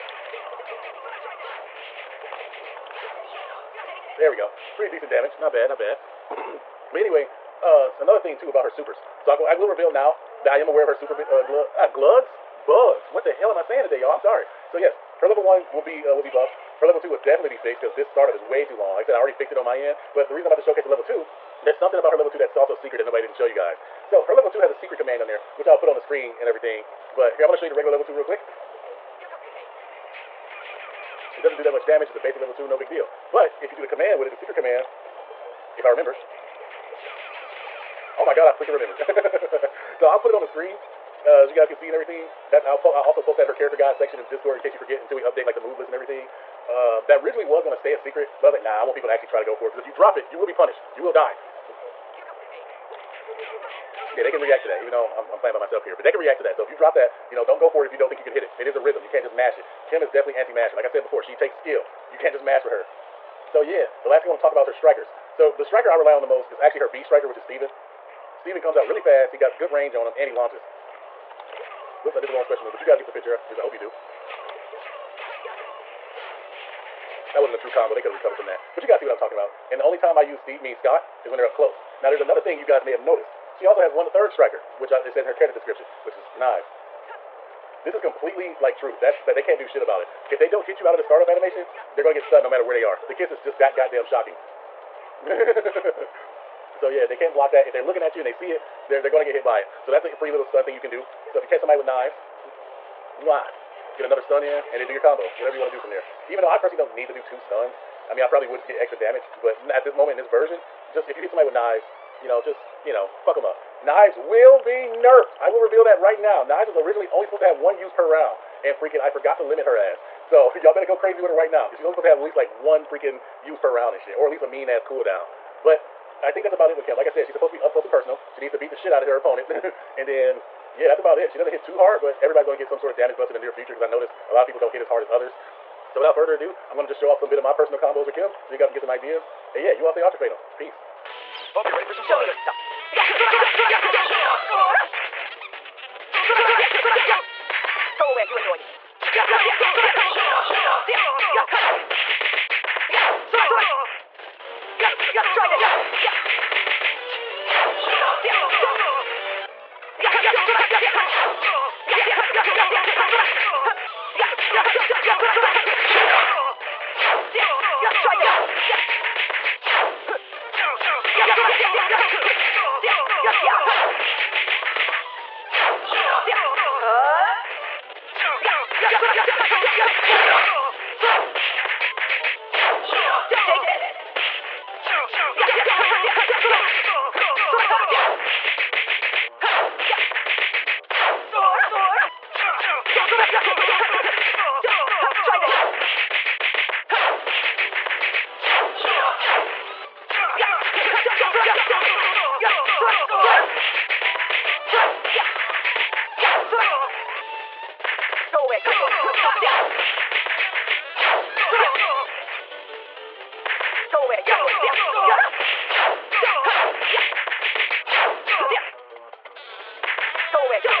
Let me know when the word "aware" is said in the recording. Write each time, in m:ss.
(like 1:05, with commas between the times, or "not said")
0:10.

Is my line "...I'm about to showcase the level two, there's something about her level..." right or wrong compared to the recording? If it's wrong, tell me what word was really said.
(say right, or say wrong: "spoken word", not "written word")
right.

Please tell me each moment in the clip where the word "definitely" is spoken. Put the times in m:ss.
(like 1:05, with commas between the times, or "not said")
0:17, 1:00.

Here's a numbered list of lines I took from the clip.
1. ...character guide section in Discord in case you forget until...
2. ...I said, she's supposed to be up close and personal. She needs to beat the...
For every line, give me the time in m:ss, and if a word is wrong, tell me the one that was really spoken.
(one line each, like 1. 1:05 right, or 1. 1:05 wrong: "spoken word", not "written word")
1. 0:43 right
2. 2:07 right.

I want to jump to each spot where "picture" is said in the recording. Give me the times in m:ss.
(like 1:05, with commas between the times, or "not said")
1:13.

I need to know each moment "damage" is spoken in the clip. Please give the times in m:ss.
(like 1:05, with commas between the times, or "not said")
0:05, 0:31, 1:48, 2:12.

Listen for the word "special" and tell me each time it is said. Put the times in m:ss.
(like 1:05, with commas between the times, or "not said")
1:12.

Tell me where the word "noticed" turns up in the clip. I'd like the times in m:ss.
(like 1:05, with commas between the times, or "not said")
1:22, 2:13.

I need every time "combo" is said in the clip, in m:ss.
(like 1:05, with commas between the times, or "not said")
1:17, 1:44, 2:17.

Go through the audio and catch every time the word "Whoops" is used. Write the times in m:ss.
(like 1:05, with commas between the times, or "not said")
1:12.